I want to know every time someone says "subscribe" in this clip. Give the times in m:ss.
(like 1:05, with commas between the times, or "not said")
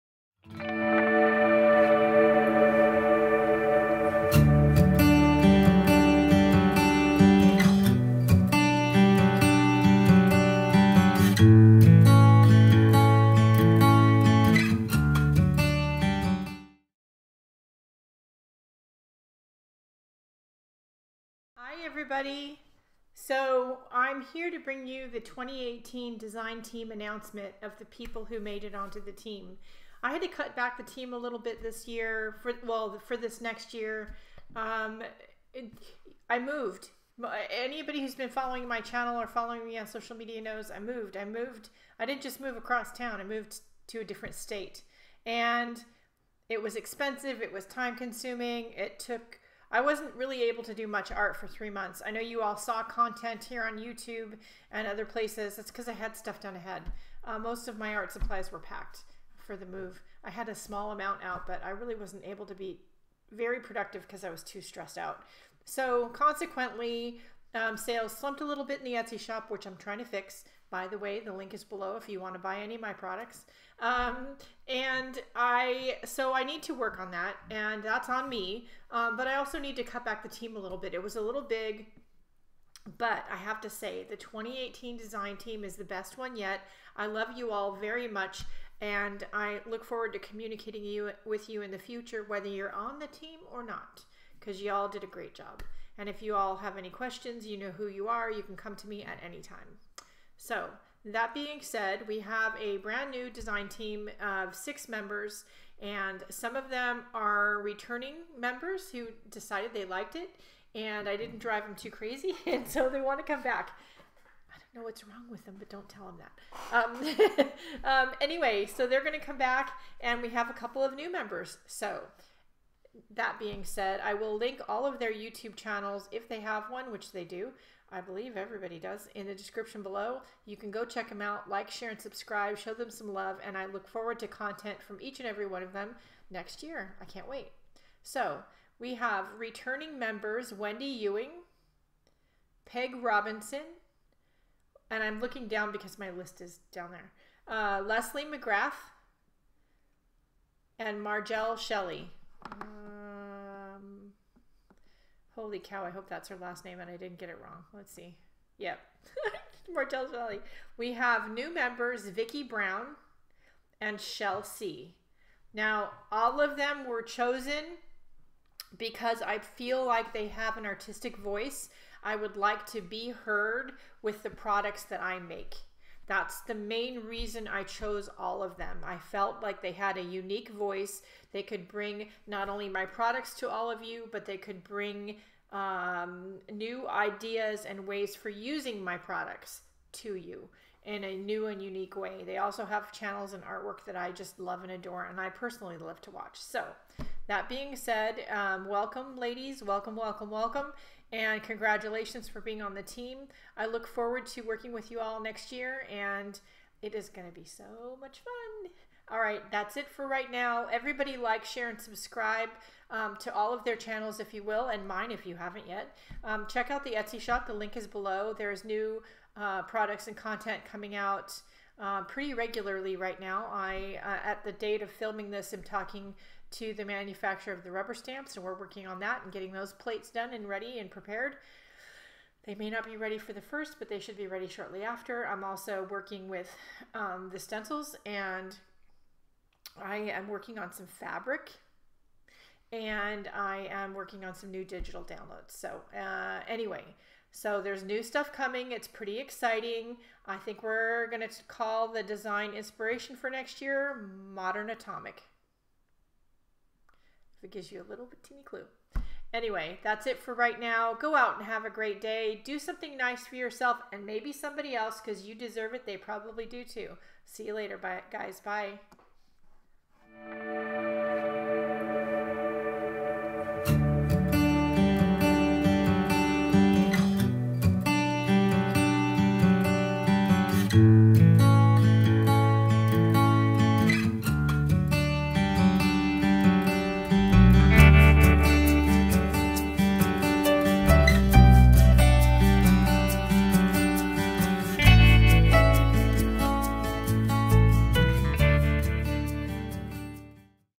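2:11, 3:31.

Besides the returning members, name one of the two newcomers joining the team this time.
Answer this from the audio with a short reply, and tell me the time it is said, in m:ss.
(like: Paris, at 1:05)
Vickie Brown, at 2:42.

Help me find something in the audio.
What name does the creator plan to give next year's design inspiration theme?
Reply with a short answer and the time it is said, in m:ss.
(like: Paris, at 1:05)
Modern Atomic, at 4:14.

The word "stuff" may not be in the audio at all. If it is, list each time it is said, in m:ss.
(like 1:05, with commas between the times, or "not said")
0:56, 4:08.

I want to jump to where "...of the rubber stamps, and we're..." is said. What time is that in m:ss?
3:47.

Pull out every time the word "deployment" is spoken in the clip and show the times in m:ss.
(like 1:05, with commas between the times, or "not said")
not said.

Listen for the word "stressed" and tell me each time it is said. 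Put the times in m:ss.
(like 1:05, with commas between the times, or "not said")
1:04.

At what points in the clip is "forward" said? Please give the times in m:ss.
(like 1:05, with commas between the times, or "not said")
1:29, 2:13, 3:23.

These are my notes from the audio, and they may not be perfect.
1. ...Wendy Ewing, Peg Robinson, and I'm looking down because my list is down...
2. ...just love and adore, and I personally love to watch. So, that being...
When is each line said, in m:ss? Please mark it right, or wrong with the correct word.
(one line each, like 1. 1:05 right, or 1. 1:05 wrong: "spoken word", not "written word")
1. 2:20 right
2. 3:14 right.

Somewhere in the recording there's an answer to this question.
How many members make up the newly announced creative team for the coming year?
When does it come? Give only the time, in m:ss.
1:44.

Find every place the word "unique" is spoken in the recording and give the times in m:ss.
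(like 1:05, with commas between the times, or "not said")
3:00, 3:11.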